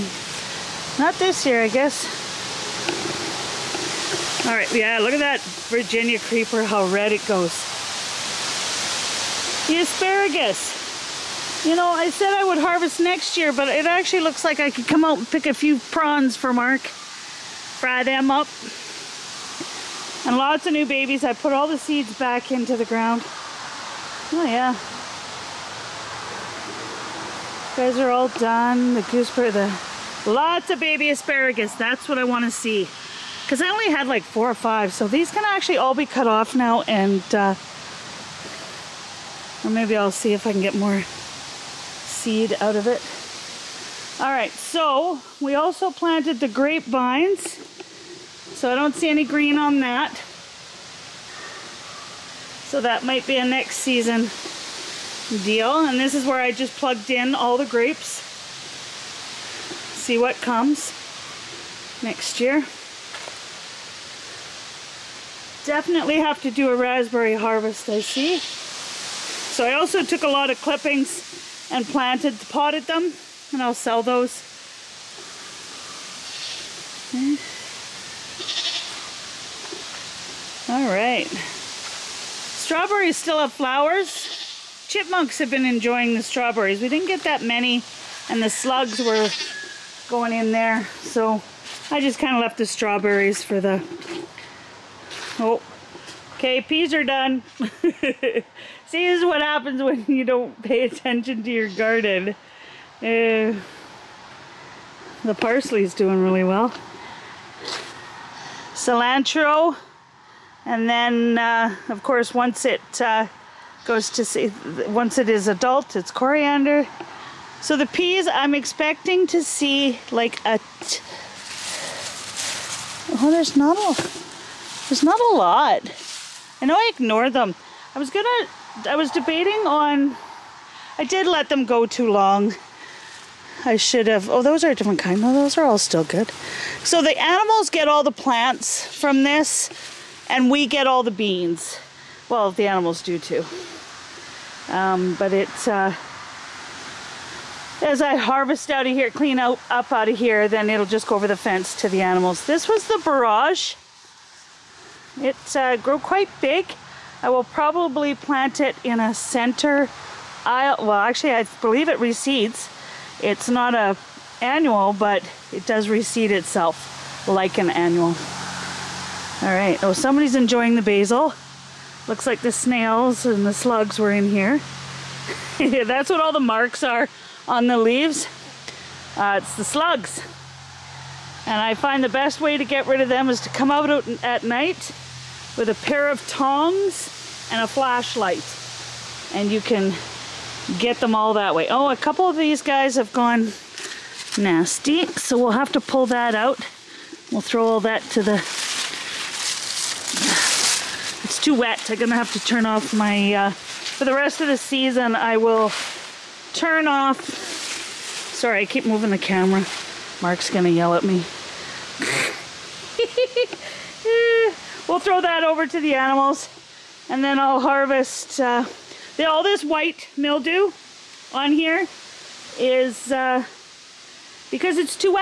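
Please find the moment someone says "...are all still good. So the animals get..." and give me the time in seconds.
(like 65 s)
135 s.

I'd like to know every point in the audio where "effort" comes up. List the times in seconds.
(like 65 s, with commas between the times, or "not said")
not said.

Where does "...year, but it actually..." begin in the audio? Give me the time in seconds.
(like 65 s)
13 s.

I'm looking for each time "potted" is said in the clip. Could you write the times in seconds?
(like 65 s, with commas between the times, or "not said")
72 s.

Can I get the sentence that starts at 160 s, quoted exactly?
Well, actually, I believe it reseeds.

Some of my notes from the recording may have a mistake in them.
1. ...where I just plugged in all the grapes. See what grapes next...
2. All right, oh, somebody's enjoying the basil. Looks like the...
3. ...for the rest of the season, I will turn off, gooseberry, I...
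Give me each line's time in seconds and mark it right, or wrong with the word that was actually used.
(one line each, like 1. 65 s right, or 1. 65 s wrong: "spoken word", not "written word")
1. 56 s wrong: "comes", not "grapes"
2. 169 s right
3. 203 s wrong: "sorry", not "gooseberry".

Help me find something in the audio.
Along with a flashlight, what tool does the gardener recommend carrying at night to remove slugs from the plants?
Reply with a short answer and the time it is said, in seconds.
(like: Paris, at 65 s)
Tongs, at 185 s.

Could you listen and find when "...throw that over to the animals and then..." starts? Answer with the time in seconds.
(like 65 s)
214 s.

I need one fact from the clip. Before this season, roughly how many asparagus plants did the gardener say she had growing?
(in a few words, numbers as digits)
4 or 5.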